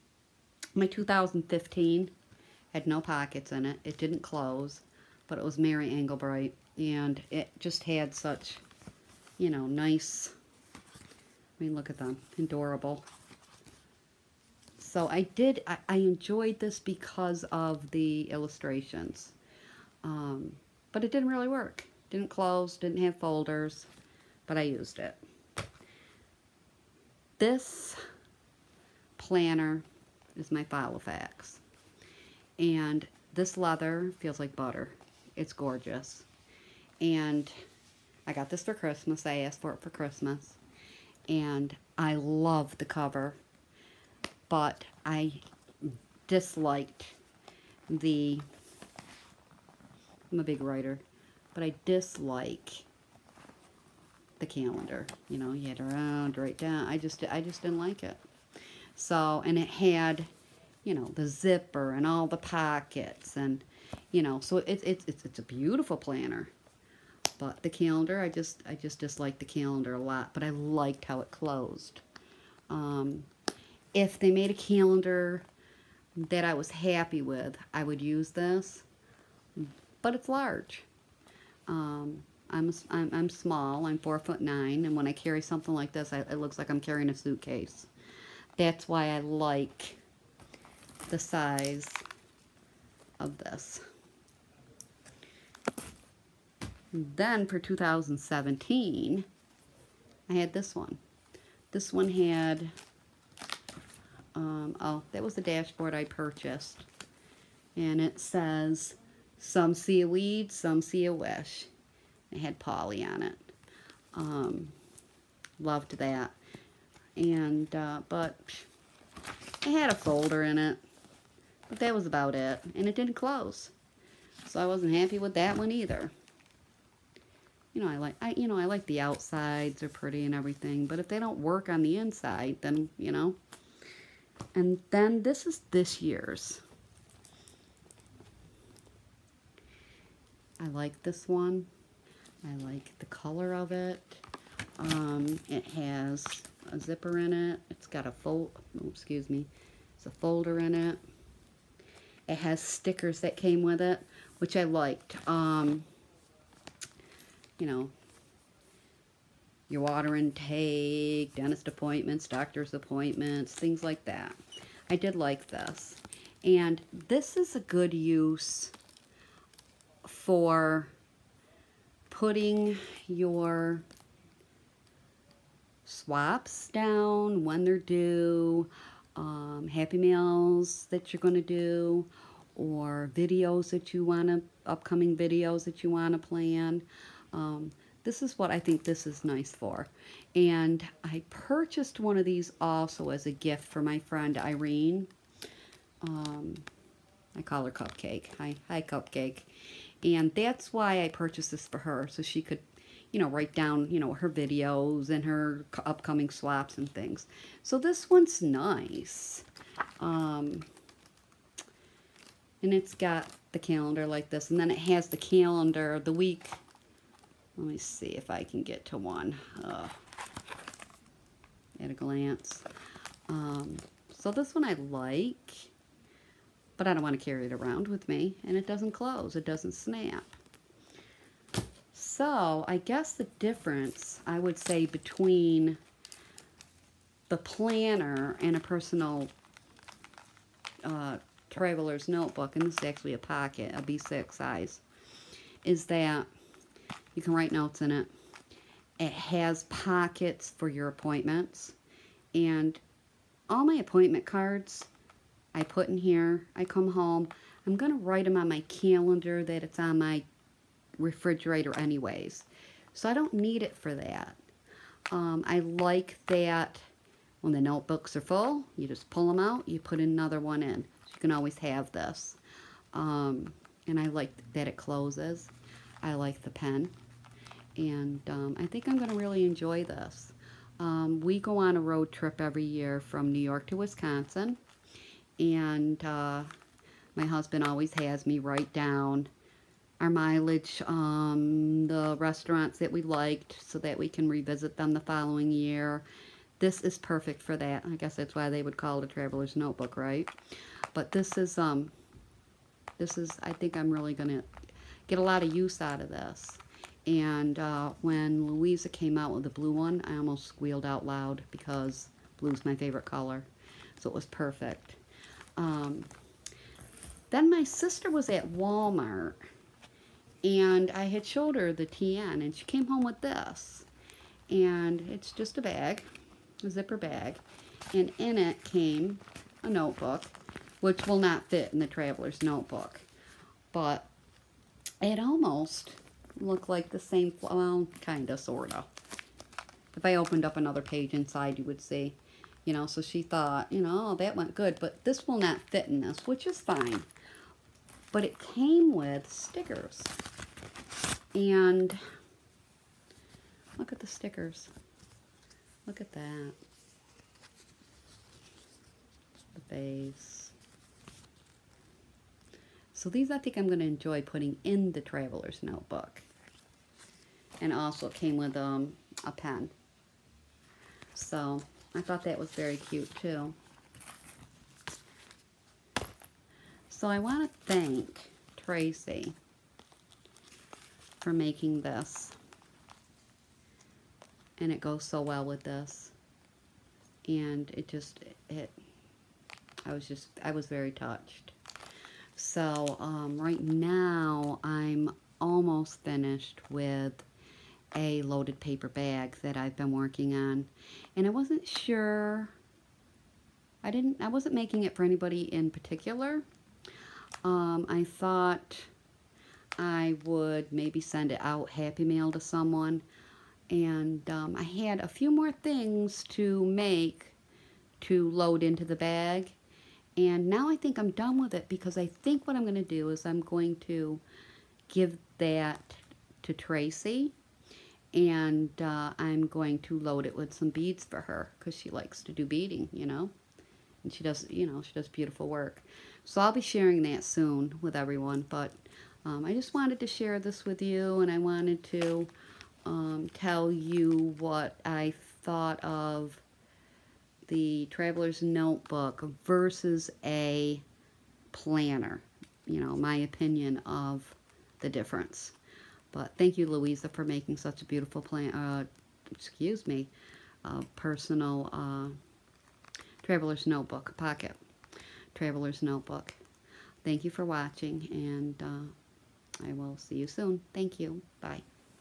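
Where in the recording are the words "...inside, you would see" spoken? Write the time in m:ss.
5:41.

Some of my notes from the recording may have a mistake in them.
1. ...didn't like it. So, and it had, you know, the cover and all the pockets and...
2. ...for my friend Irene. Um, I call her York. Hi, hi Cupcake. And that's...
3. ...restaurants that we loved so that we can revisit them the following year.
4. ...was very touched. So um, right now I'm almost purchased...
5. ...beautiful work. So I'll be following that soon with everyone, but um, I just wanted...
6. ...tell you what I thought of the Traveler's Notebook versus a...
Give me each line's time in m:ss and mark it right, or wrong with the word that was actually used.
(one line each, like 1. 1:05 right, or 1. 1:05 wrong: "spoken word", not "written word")
1. 0:57 wrong: "zipper", not "cover"
2. 3:13 wrong: "Cupcake", not "York"
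3. 4:52 wrong: "liked", not "loved"
4. 6:30 wrong: "finished", not "purchased"
5. 7:15 wrong: "sharing", not "following"
6. 7:23 right.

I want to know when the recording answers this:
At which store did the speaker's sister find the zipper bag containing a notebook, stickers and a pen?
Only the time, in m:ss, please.
5:18.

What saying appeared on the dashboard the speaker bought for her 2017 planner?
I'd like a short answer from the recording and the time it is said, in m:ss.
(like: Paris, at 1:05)
Some see a weed, some see a wish, at 1:49.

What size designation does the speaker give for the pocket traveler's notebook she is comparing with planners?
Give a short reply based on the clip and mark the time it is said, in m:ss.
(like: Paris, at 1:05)
B6, at 4:03.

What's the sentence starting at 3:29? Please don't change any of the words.
Um, and it's got the calendar like this.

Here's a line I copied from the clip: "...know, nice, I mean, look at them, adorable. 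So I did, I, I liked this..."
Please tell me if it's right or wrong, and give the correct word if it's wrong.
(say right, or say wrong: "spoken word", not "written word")
wrong: "enjoyed", not "liked".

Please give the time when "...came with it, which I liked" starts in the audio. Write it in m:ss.
2:33.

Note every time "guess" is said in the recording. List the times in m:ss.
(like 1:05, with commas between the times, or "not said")
3:52, 4:57.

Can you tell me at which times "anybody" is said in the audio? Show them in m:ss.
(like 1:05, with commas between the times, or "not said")
6:45.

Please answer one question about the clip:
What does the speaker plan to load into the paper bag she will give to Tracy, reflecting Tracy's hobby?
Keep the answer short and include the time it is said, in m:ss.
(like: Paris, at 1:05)
Beads, at 7:10.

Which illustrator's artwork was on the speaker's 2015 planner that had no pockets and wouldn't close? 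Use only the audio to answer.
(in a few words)
Mary Engelbreit.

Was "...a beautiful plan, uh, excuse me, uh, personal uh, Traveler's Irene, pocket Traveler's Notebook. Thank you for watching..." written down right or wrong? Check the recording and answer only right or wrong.
wrong.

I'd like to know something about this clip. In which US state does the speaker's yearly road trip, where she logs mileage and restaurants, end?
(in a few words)
Wisconsin.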